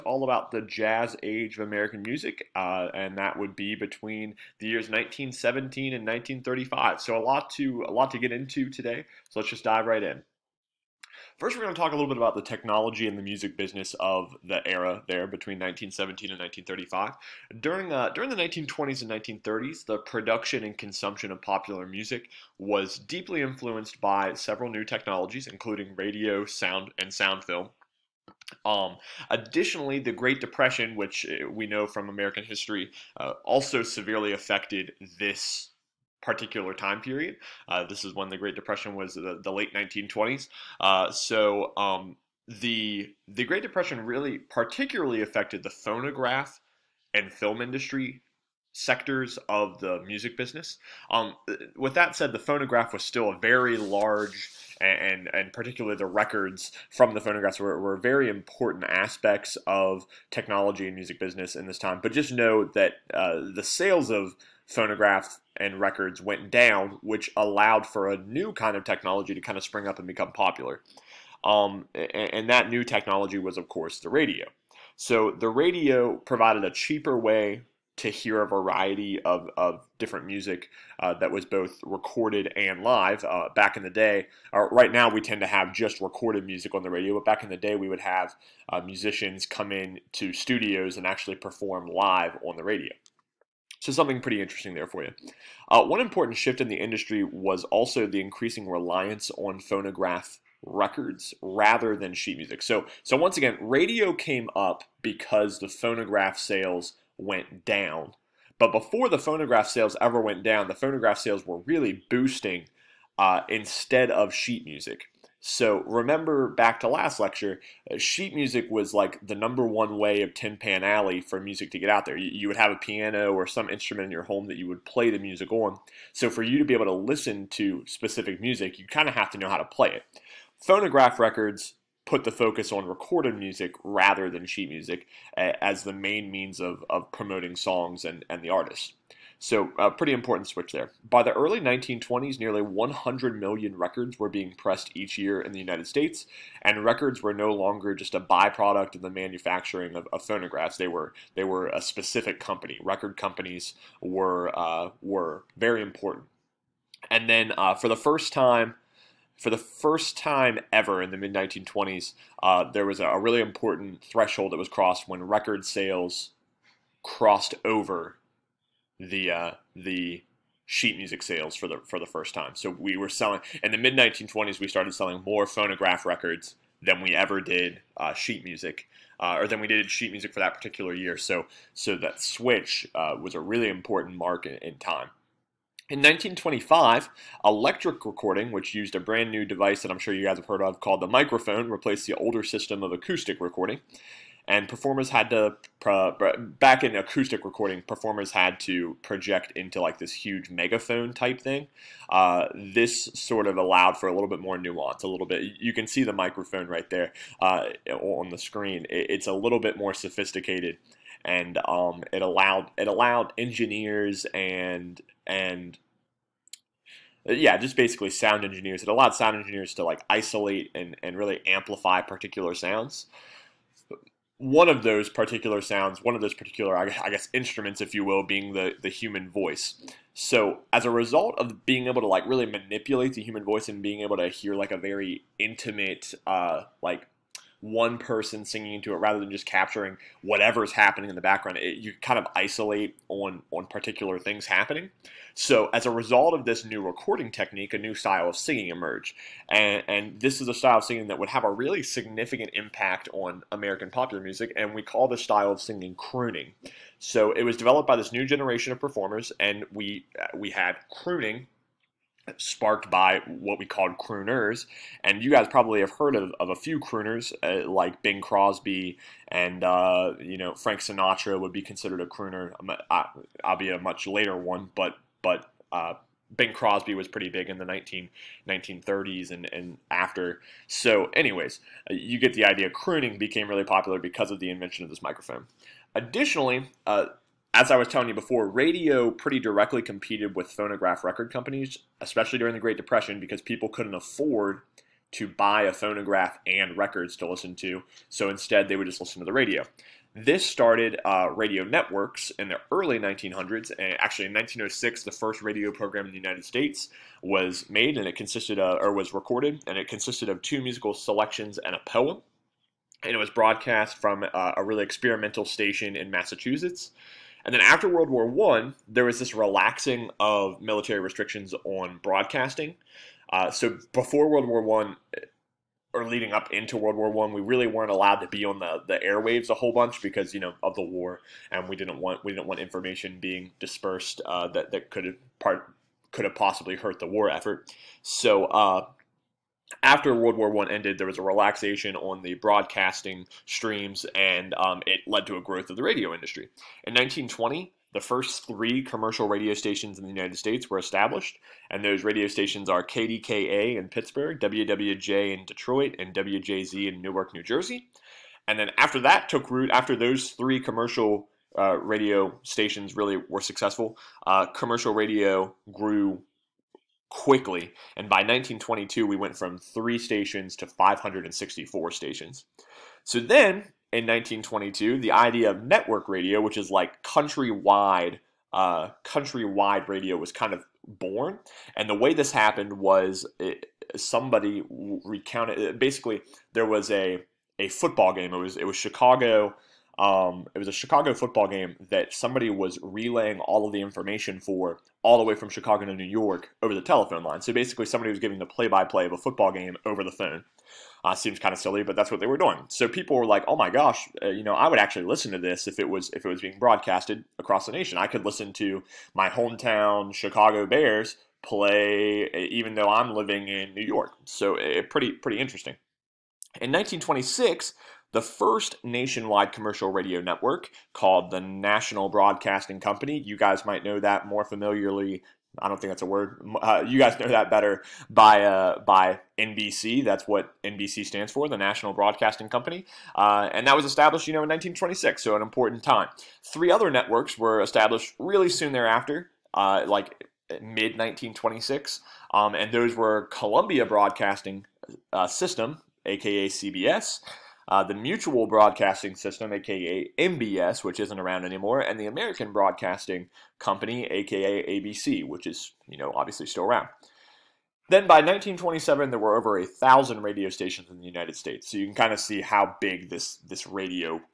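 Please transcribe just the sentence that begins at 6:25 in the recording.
Basically, there was a a football game.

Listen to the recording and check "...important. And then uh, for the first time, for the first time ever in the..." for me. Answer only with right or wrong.
right.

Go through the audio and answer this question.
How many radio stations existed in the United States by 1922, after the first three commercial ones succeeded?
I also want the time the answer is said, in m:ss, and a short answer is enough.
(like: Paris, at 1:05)
564, at 6:10.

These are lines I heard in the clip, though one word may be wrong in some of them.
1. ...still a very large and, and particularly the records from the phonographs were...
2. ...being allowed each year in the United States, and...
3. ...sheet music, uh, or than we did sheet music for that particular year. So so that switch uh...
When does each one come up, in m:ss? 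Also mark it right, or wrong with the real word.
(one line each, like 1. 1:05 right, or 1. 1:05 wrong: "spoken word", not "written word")
1. 0:53 right
2. 2:24 wrong: "pressed", not "allowed"
3. 2:58 right.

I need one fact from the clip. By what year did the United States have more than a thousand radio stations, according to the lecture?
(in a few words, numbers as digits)
1927.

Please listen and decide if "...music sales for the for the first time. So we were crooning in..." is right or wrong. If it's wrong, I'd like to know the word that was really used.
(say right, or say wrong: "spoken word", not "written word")
wrong: "selling", not "crooning".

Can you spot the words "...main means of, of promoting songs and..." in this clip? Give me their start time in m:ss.
2:15.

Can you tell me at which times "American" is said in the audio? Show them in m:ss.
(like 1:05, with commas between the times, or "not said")
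0:01, 0:32, 4:13, 7:32.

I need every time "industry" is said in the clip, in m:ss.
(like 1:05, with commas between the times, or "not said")
0:47, 1:36, 5:46.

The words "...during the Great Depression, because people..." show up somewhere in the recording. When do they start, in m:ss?
4:52.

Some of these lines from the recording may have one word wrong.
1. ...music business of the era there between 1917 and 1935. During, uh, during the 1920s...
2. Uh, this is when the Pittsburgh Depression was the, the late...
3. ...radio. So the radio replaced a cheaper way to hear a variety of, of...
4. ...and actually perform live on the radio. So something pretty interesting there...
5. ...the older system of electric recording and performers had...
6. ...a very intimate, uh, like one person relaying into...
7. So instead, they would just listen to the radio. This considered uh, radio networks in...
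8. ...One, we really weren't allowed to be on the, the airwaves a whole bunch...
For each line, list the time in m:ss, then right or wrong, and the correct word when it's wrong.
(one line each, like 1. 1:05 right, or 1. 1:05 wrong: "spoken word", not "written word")
1. 0:13 right
2. 0:37 wrong: "Great", not "Pittsburgh"
3. 1:14 wrong: "provided", not "replaced"
4. 1:30 right
5. 3:12 wrong: "acoustic", not "electric"
6. 3:54 wrong: "singing", not "relaying"
7. 4:58 wrong: "started", not "considered"
8. 5:27 right.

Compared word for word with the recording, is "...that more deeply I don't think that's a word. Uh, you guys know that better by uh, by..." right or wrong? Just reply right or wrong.
wrong.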